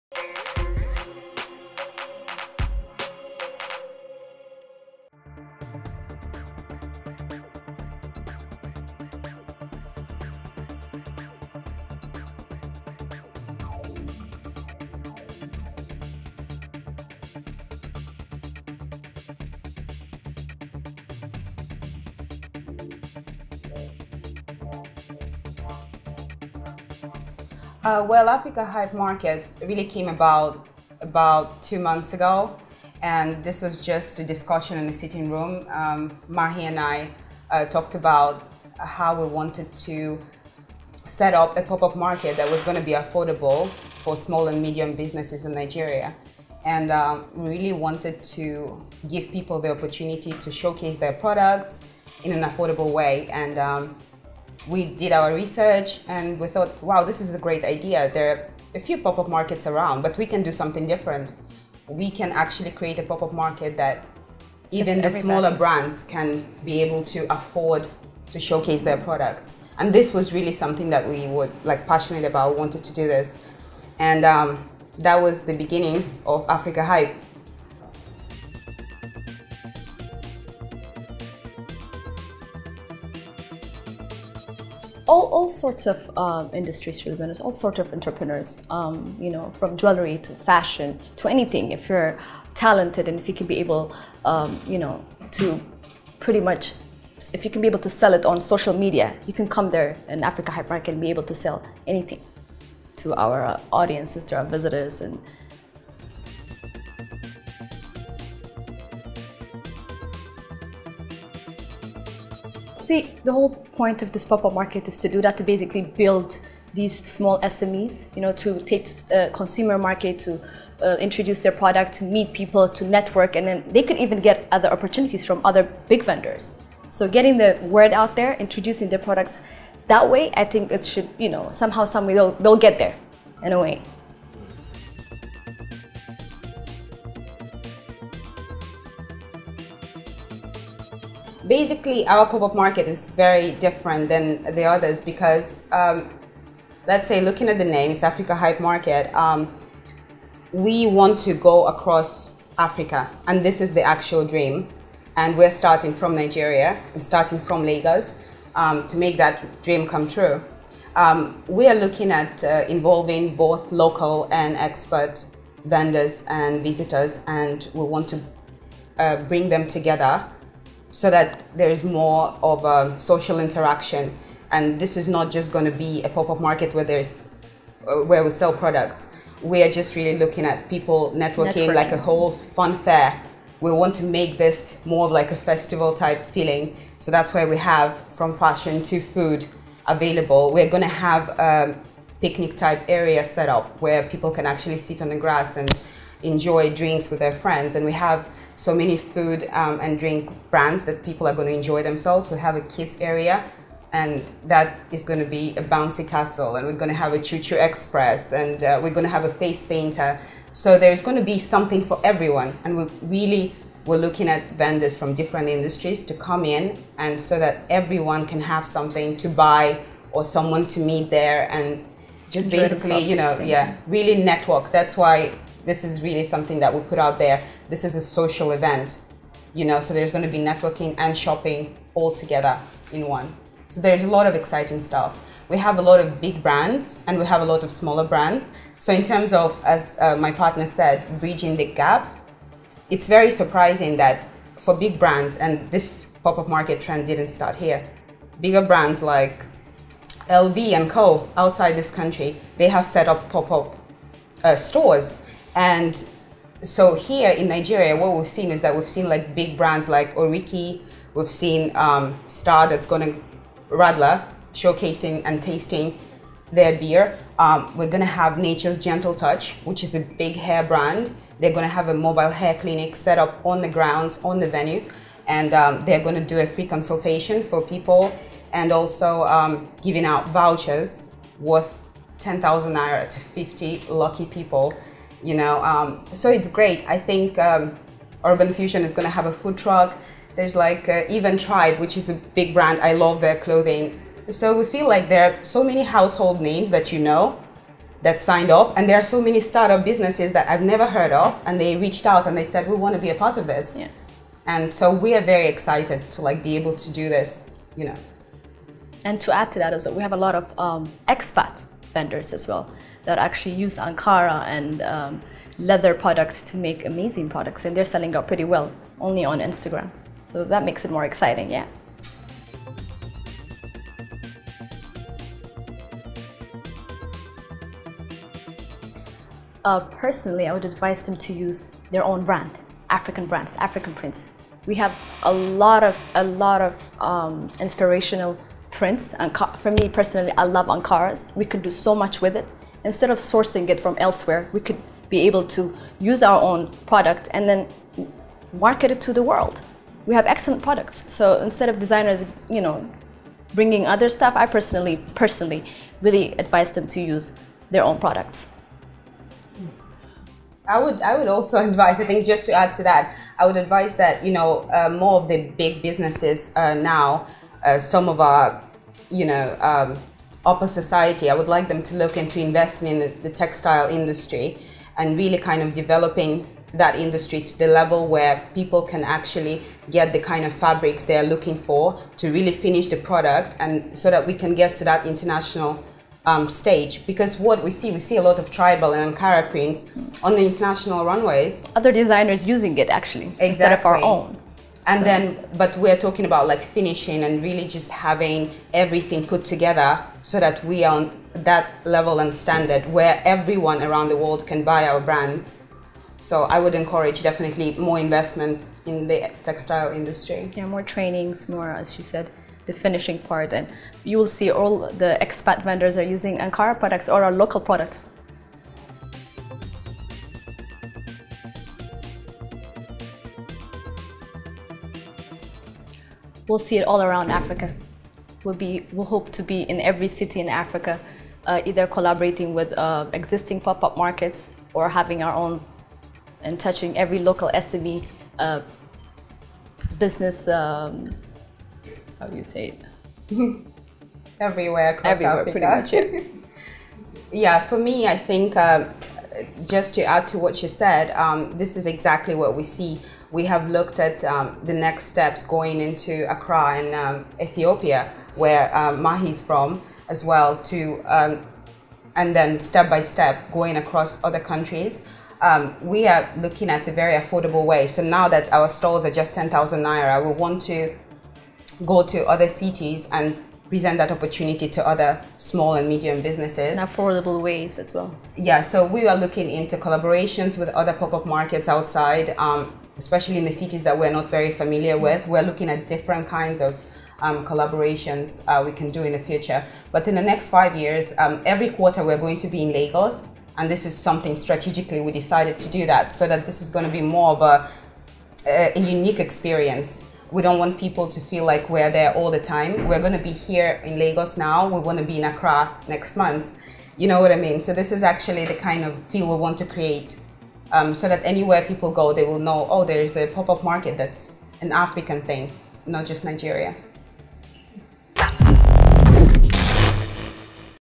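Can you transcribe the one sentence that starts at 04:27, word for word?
Um, we're going to have Nature's Gentle Touch, which is a big hair brand.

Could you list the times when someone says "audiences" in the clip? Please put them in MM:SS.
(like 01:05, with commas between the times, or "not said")
01:43.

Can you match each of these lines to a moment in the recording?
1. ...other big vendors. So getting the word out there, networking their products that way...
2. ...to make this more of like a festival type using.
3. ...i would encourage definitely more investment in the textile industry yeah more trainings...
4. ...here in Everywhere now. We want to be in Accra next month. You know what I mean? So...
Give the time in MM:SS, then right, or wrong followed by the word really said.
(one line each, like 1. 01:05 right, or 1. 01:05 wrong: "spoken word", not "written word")
1. 02:05 wrong: "introducing", not "networking"
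2. 03:03 wrong: "feeling", not "using"
3. 06:46 right
4. 08:23 wrong: "Lagos", not "Everywhere".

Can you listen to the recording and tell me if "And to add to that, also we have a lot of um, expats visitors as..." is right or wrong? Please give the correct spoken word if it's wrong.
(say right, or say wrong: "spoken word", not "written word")
wrong: "vendors", not "visitors".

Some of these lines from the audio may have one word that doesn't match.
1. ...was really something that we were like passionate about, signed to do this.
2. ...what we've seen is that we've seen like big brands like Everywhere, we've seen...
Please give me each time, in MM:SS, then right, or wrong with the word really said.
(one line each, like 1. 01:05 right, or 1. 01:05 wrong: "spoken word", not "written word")
1. 01:10 wrong: "wanted", not "signed"
2. 04:17 wrong: "Oriki", not "Everywhere".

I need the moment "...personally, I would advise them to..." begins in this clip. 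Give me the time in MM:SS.
05:29.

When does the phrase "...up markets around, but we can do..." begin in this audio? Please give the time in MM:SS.
00:59.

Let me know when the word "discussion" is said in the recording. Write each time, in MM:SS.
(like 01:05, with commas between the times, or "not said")
00:34.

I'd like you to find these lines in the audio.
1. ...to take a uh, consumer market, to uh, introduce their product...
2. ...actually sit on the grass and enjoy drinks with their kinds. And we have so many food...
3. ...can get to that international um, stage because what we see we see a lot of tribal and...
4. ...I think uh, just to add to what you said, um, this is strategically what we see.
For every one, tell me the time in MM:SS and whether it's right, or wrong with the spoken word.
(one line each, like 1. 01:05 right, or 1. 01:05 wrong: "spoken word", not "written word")
1. 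01:58 right
2. 03:14 wrong: "friends", not "kinds"
3. 06:24 right
4. 07:28 wrong: "exactly", not "strategically".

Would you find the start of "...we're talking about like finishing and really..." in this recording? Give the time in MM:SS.
06:35.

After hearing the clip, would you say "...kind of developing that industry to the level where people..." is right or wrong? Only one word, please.
right.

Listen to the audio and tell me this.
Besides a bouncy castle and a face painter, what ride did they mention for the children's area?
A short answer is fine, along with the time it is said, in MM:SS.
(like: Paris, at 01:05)
choo-choo express, at 03:27.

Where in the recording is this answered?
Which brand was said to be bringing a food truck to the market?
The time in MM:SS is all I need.
04:48.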